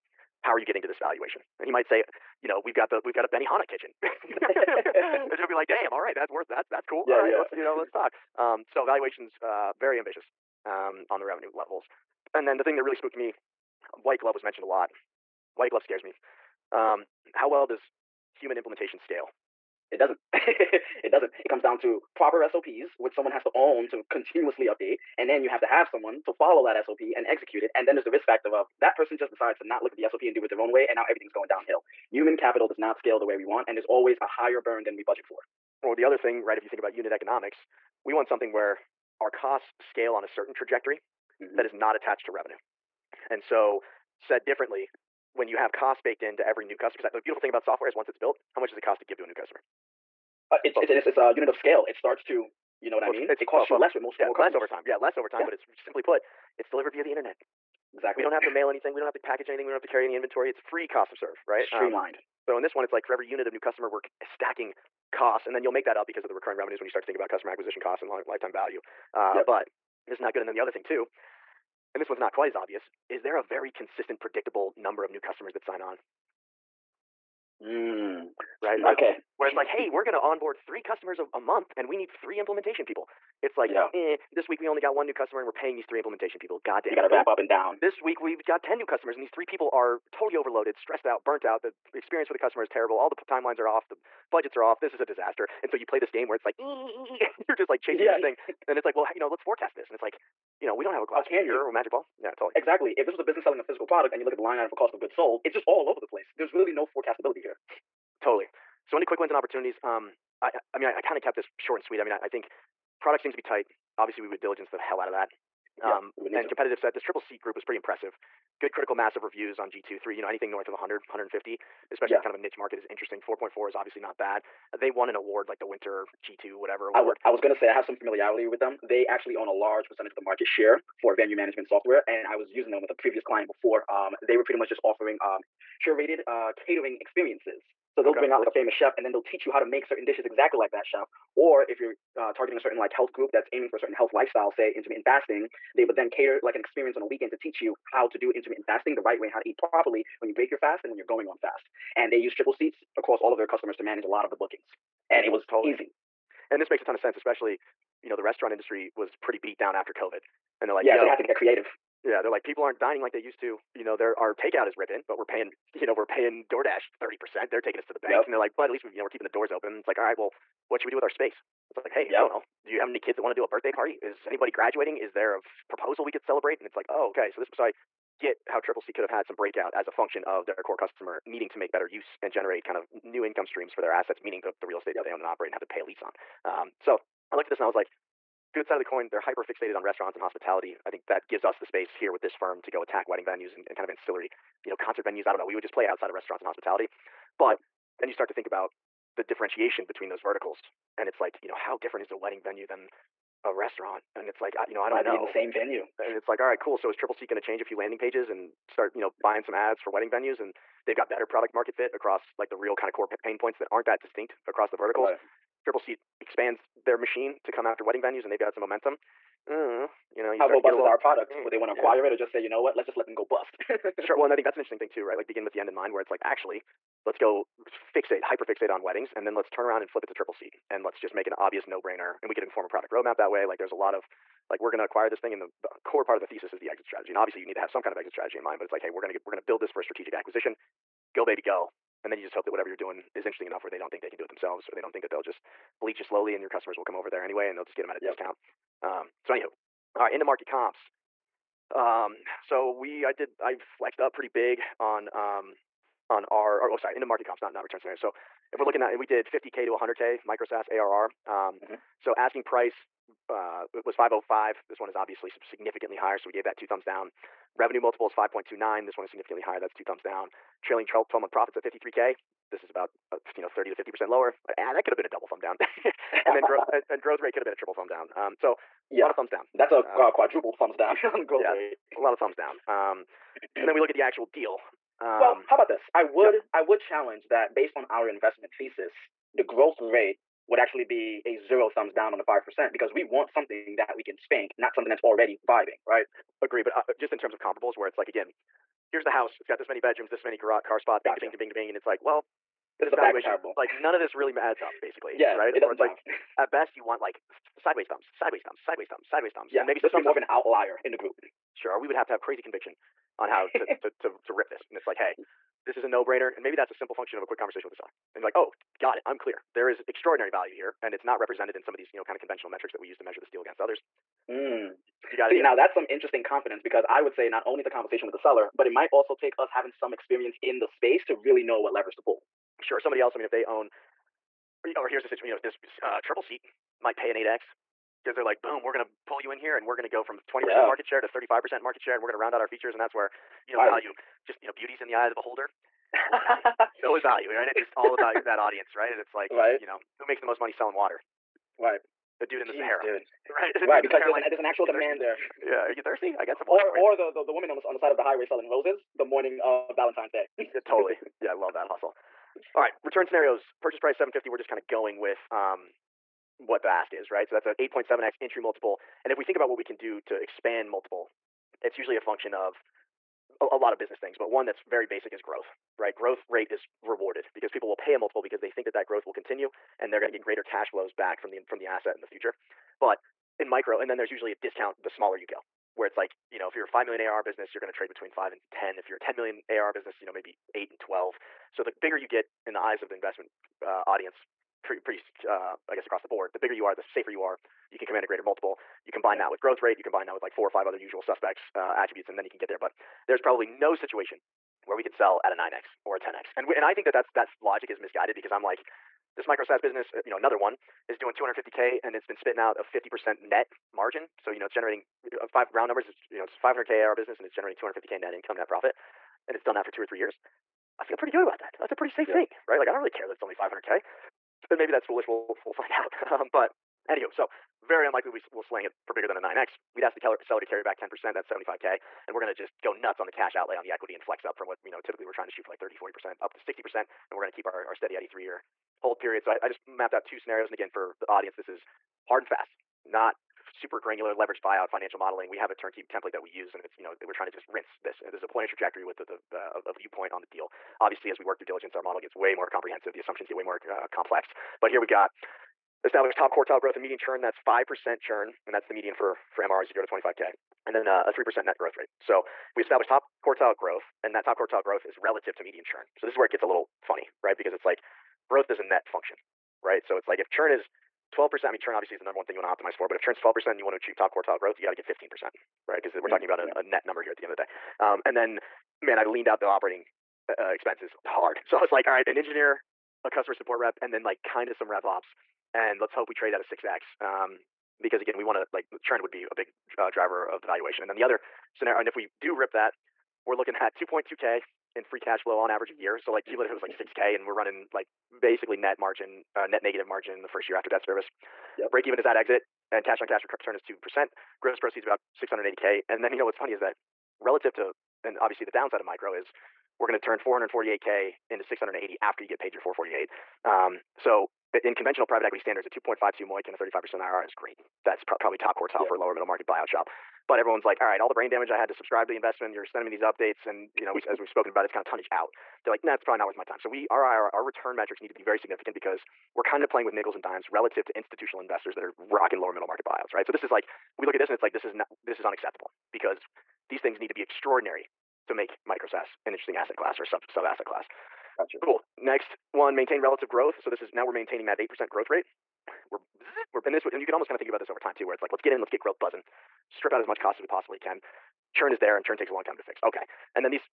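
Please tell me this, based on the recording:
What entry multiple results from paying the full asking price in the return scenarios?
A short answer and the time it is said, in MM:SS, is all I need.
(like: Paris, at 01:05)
8.7x, at 06:07.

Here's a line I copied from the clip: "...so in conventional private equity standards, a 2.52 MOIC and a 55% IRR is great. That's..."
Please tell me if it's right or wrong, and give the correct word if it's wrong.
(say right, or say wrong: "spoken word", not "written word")
wrong: "35", not "55".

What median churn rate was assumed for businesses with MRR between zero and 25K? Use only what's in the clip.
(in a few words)
5 percent.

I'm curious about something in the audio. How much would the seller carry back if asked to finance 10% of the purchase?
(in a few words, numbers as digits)
75K.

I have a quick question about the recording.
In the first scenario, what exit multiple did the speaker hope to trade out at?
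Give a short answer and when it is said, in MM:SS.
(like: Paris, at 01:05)
6X, at 08:06.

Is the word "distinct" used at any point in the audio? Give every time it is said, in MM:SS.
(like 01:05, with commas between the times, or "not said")
03:34.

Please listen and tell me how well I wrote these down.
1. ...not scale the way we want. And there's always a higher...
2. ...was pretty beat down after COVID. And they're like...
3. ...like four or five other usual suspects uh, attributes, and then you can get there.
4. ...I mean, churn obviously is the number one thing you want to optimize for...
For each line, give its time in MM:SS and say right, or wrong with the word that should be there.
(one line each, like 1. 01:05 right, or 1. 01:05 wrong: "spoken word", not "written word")
1. 00:32 right
2. 02:38 right
3. 06:40 right
4. 07:51 right.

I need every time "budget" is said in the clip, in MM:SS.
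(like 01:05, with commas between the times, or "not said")
00:35, 01:34.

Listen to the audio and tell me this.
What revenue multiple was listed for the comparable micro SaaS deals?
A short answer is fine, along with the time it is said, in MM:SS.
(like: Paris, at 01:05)
5.29, at 04:28.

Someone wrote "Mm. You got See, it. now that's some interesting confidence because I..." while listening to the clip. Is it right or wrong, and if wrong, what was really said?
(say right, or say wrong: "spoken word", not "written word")
right.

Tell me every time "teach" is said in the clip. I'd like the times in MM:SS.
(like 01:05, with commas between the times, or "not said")
02:19, 02:27.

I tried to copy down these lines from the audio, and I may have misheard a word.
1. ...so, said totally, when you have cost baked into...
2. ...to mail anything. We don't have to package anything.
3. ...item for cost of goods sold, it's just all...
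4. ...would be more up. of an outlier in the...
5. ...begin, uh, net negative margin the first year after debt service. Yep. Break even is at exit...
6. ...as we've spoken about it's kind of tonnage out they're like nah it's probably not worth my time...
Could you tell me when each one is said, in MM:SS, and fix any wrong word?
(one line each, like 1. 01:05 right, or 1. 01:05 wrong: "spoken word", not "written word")
1. 00:43 wrong: "differently", not "totally"
2. 00:58 right
3. 01:44 right
4. 05:09 right
5. 08:18 wrong: "margin", not "begin"
6. 08:44 right.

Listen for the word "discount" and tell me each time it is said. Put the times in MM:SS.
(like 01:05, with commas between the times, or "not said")
04:08, 06:24.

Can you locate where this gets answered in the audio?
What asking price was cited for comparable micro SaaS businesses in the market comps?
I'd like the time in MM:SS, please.
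04:23.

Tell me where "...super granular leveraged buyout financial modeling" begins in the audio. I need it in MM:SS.
07:23.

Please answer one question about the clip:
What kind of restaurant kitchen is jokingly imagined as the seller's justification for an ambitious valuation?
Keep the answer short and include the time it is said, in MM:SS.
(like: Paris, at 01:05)
Benihana kitchen, at 00:03.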